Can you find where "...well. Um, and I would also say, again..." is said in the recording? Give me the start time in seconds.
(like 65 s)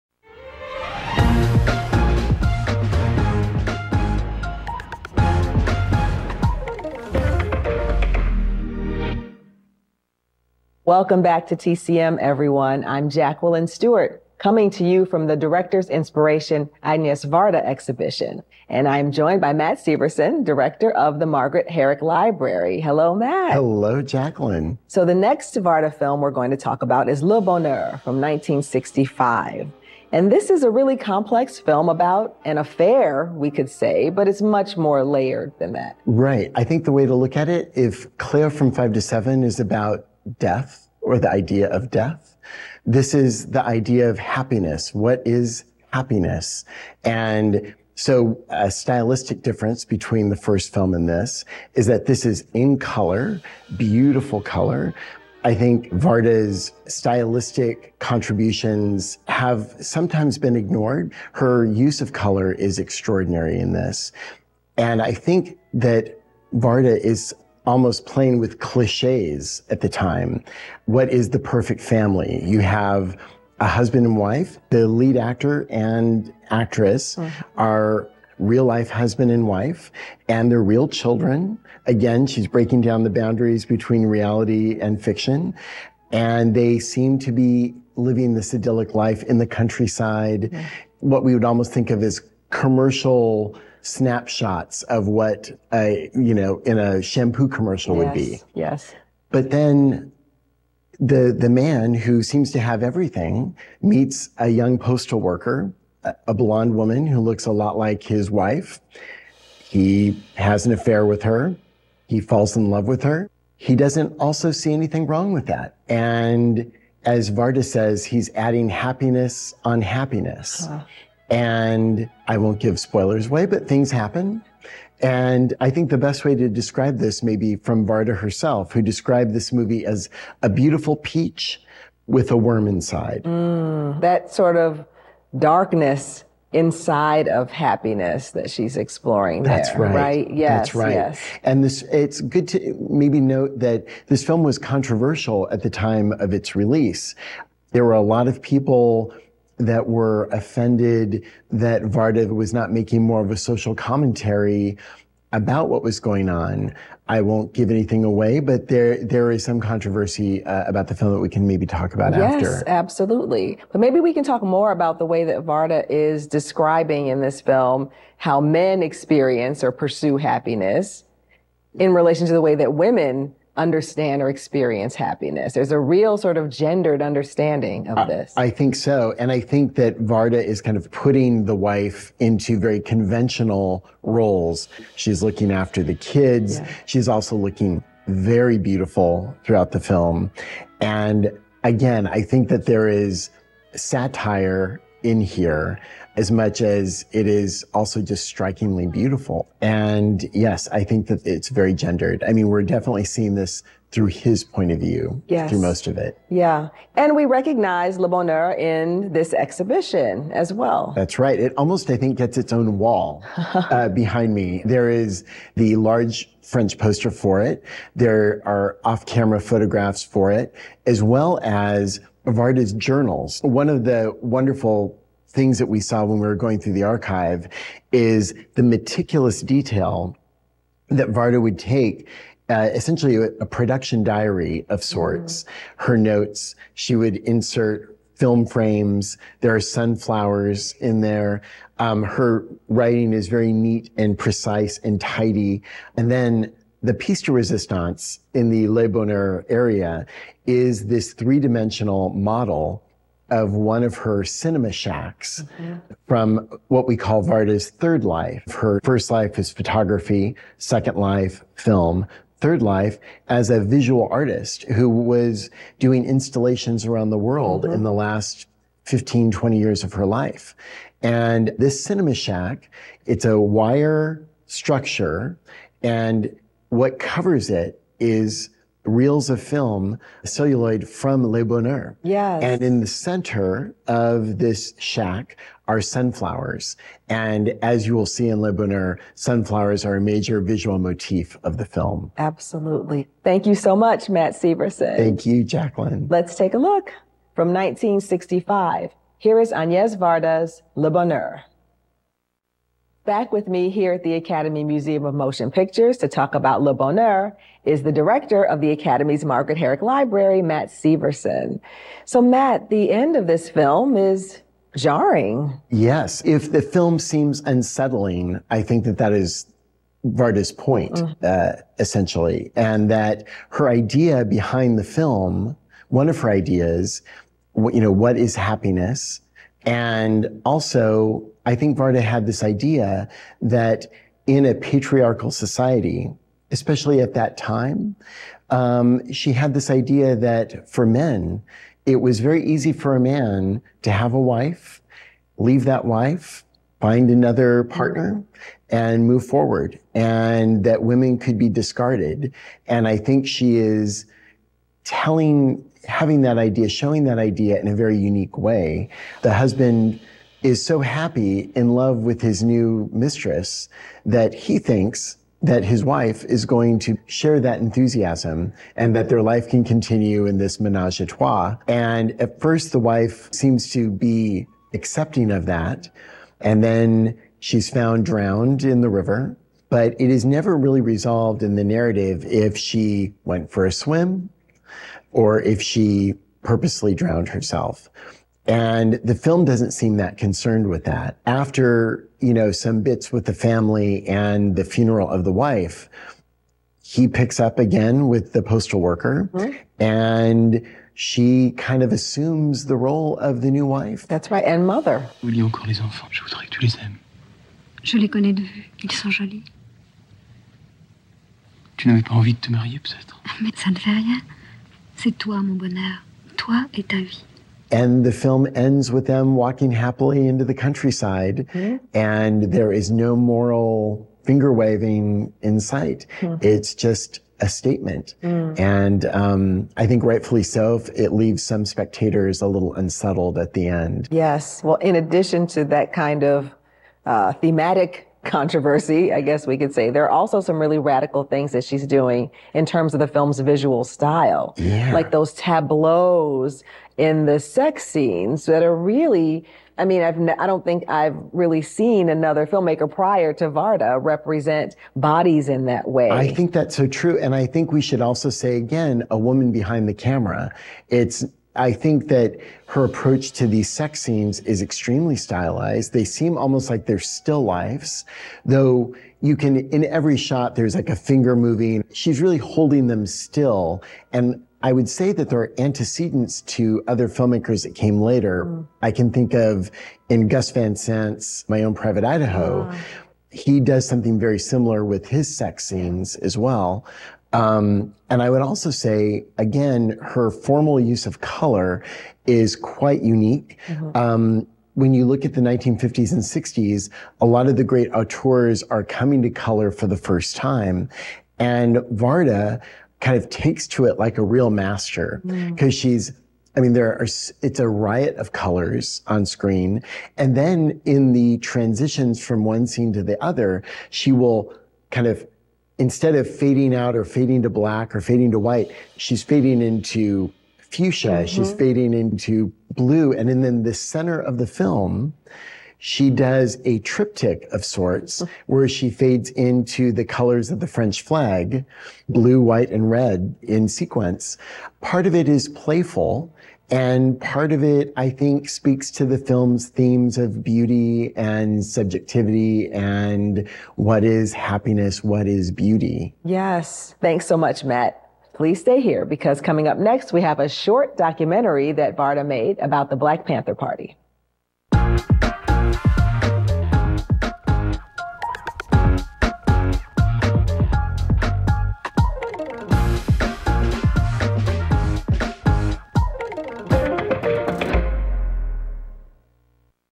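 486 s.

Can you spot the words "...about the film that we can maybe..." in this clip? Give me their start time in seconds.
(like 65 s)
160 s.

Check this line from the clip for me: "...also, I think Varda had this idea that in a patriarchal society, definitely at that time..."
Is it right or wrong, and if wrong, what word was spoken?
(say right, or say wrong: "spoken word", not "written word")
wrong: "especially", not "definitely".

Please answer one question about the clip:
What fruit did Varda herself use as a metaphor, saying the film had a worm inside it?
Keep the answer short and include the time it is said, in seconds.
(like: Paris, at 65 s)
Peach, at 130 s.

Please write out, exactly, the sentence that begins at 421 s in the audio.
and there is no moral finger waving in sight.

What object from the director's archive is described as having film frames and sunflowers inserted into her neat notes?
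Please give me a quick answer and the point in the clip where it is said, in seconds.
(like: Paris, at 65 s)
Journals, at 222 s.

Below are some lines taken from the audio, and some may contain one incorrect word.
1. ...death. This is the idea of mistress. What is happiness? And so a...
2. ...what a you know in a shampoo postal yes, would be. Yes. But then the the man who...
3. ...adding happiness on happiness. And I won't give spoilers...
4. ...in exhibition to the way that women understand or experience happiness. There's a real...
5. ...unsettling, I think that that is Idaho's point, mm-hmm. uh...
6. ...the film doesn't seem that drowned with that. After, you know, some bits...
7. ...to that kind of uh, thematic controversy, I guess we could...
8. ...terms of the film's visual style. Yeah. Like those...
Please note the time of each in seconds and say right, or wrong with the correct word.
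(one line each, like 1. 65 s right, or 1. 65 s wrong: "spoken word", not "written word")
1. 41 s wrong: "happiness", not "mistress"
2. 95 s wrong: "commercial", not "postal"
3. 118 s right
4. 171 s wrong: "relation", not "exhibition"
5. 317 s wrong: "Varda", not "Idaho"
6. 389 s wrong: "concerned", not "drowned"
7. 435 s right
8. 442 s right.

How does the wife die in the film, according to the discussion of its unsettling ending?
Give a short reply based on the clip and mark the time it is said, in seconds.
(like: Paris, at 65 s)
Drowned in the river, at 378 s.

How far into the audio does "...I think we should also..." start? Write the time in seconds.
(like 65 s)
457 s.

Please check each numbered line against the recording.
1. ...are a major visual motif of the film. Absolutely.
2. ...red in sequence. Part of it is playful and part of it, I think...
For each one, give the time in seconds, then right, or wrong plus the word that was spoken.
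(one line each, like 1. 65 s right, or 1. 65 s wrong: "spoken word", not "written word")
1. 289 s right
2. 532 s right.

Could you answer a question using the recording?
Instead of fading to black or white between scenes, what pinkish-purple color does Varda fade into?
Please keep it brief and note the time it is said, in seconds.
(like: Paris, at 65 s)
Fuchsia, at 520 s.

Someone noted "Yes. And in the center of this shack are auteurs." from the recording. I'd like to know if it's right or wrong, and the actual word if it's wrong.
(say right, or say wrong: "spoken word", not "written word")
wrong: "sunflowers", not "auteurs".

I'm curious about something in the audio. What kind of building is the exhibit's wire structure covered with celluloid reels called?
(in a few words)
Cinema shack.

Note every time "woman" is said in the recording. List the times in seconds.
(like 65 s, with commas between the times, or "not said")
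106 s, 459 s.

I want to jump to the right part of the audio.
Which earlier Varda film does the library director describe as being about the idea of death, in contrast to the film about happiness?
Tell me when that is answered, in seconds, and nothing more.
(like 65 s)
38 s.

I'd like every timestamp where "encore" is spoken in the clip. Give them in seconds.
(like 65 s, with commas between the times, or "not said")
405 s.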